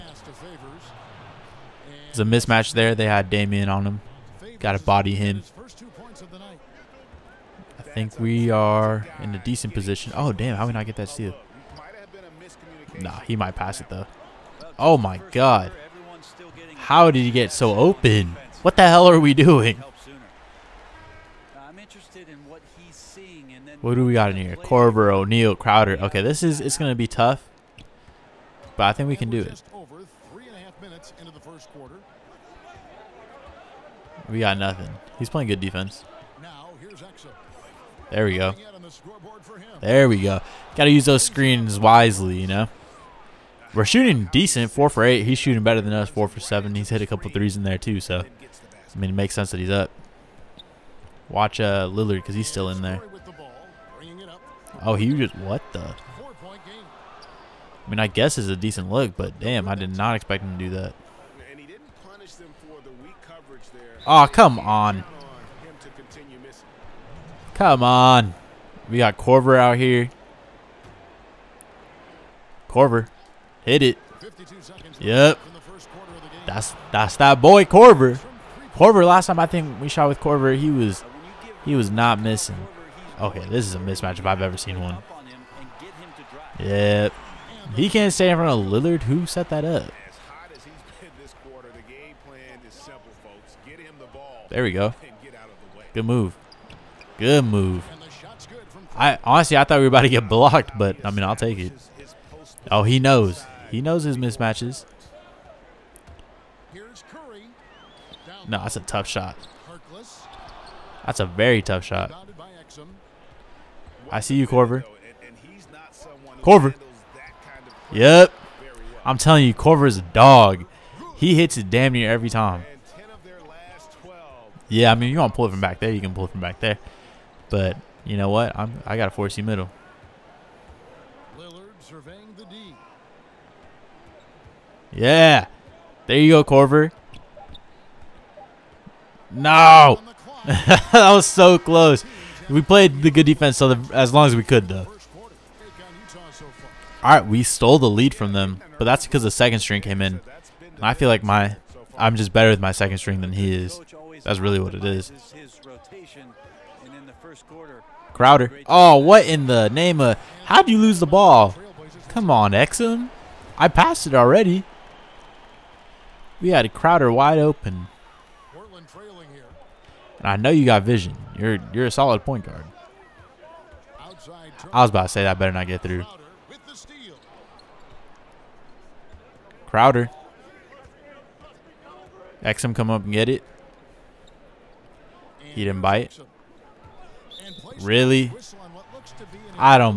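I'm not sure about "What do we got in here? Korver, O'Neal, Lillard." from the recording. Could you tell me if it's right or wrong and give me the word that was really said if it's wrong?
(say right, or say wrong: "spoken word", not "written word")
wrong: "Crowder", not "Lillard".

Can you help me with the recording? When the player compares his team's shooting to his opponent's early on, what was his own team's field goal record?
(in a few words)
4 for 8.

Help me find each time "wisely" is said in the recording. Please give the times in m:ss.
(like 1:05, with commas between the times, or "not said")
0:41.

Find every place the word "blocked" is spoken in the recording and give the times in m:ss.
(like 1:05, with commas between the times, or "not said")
1:40.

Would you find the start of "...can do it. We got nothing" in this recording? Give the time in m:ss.
0:29.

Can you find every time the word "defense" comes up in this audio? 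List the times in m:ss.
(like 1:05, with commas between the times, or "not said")
0:35, 2:23.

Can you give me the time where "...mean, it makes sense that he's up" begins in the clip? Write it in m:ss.
0:48.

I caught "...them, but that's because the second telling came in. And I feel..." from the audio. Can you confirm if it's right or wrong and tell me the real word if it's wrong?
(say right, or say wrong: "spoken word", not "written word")
wrong: "string", not "telling".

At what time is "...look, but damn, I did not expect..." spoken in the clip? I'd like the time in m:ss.
0:58.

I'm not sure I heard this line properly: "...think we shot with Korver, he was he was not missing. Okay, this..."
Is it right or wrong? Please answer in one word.
right.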